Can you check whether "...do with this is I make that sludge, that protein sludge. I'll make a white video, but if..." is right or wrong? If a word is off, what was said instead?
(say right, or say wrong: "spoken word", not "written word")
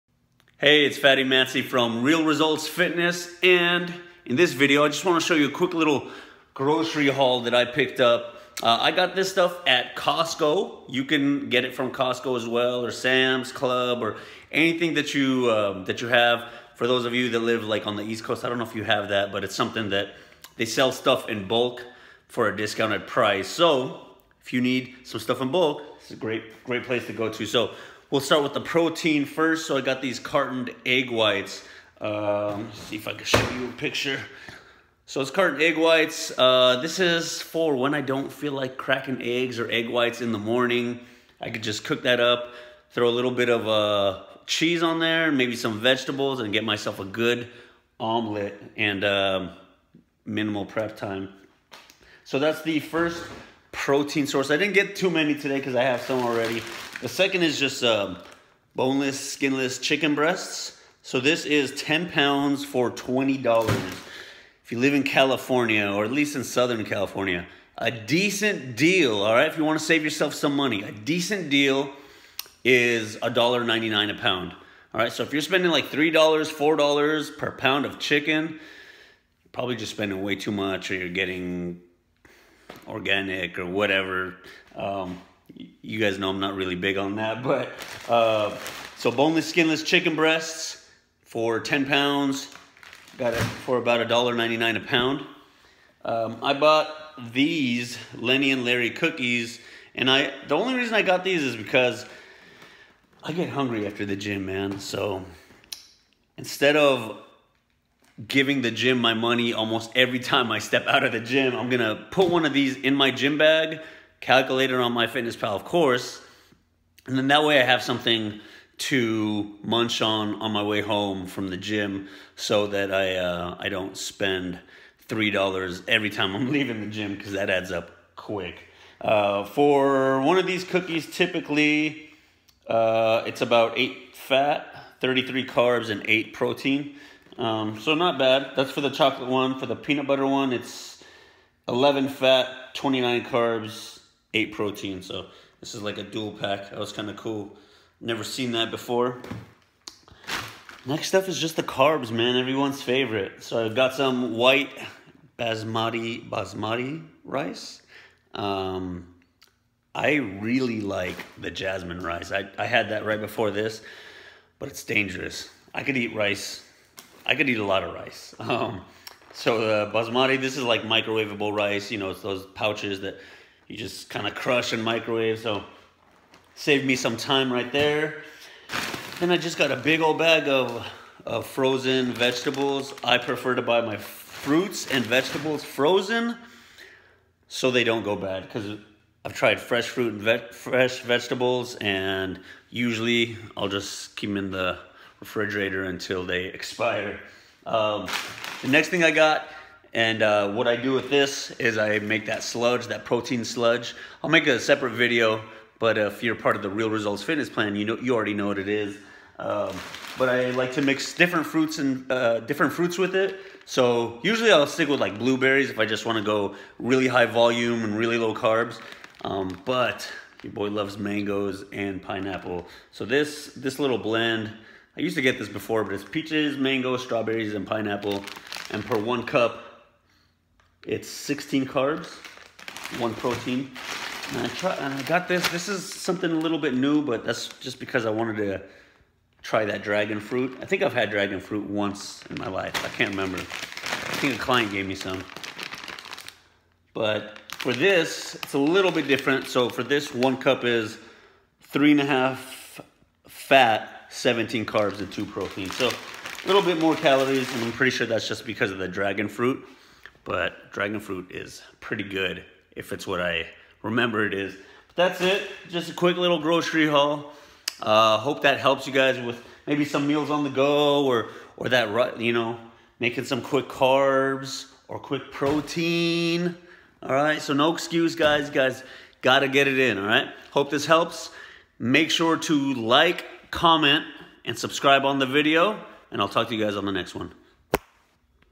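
wrong: "separate", not "white".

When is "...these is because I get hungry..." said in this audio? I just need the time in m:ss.
1:41.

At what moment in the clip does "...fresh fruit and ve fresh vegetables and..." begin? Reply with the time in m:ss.
3:09.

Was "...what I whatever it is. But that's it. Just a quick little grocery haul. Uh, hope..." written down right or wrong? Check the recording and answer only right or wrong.
wrong.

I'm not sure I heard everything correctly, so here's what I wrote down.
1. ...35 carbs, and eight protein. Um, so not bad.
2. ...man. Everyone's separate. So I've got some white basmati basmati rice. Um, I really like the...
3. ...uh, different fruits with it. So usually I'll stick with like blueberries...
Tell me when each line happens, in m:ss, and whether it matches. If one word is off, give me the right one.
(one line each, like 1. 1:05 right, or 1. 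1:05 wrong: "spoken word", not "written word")
1. 2:14 wrong: "33", not "35"
2. 2:32 wrong: "favorite", not "separate"
3. 3:32 right.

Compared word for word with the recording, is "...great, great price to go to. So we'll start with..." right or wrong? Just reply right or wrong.
wrong.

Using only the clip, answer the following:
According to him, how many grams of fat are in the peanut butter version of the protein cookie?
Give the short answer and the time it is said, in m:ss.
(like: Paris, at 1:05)
11, at 2:21.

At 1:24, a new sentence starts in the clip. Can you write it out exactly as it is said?
Um, you guys know I'm not really big on that, but uh, so boneless, skinless chicken breasts for 10 pounds.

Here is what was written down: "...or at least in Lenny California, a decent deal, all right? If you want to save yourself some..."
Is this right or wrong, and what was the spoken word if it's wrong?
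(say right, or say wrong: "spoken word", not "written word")
wrong: "Southern", not "Lenny".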